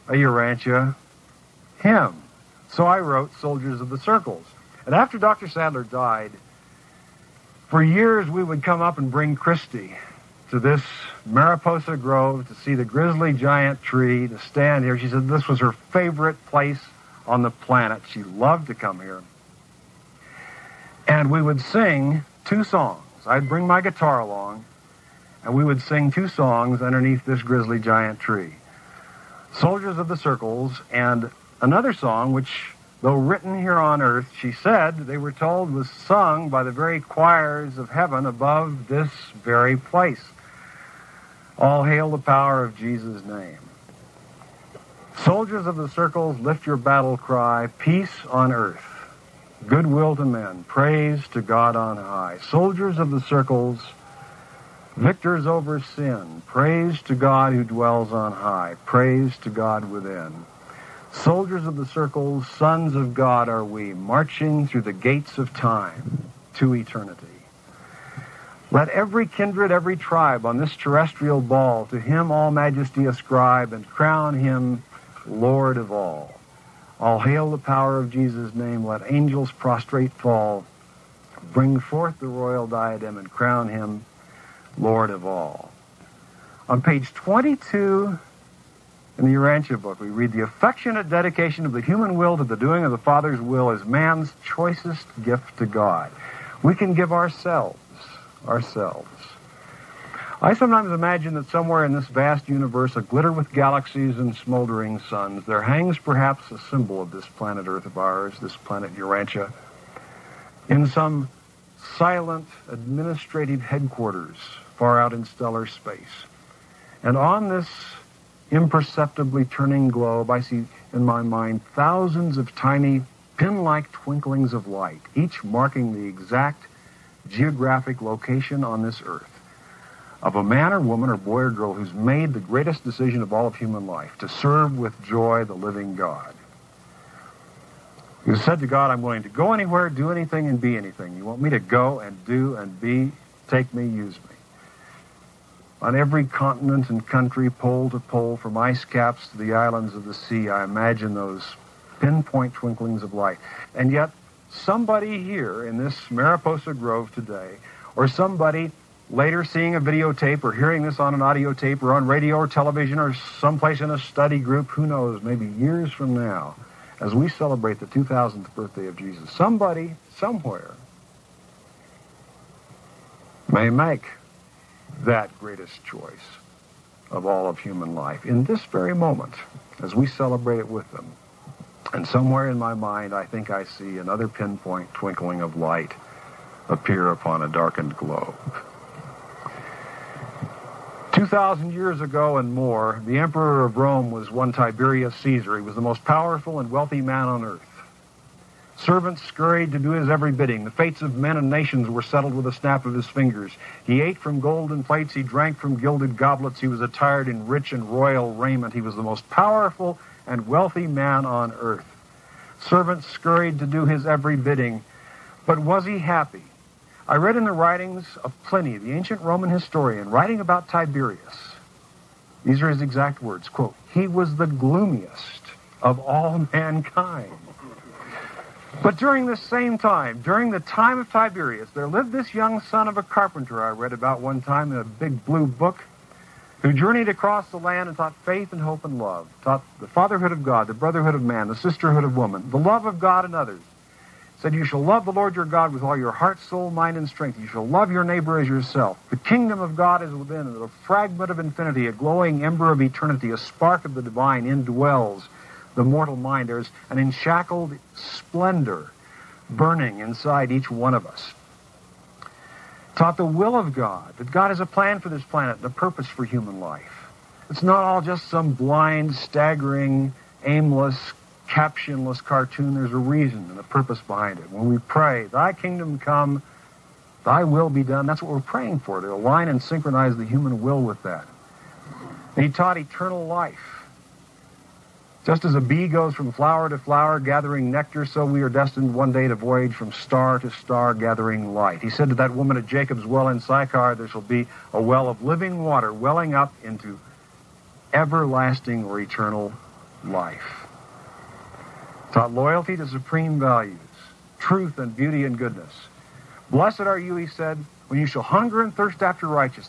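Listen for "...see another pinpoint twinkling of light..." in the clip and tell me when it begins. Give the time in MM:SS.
03:03.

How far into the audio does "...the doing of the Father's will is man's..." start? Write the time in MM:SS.
01:32.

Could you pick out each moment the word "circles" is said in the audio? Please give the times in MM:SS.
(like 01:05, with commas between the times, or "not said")
00:03, 00:30, 00:45, 00:53, 01:01.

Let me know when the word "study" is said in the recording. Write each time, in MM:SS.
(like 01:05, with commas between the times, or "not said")
02:43.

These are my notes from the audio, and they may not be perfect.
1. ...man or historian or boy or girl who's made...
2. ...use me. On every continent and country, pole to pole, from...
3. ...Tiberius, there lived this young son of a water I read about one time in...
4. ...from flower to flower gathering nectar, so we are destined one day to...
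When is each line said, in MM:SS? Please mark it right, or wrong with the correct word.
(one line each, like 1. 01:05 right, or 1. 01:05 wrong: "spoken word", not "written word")
1. 02:10 wrong: "woman", not "historian"
2. 02:23 right
3. 03:51 wrong: "carpenter", not "water"
4. 04:46 right.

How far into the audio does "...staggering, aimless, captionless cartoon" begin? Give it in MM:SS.
04:29.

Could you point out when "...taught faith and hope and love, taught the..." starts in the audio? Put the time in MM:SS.
03:57.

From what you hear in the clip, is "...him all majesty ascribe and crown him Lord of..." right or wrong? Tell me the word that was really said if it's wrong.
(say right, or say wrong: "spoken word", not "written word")
right.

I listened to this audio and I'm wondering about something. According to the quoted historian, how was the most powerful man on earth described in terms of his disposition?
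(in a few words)
the gloomiest of all mankind.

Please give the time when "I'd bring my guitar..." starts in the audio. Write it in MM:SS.
00:23.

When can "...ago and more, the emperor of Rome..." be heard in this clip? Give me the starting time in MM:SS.
03:12.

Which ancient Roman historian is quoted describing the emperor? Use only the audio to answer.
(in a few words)
Pliny.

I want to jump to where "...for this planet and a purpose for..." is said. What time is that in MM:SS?
04:24.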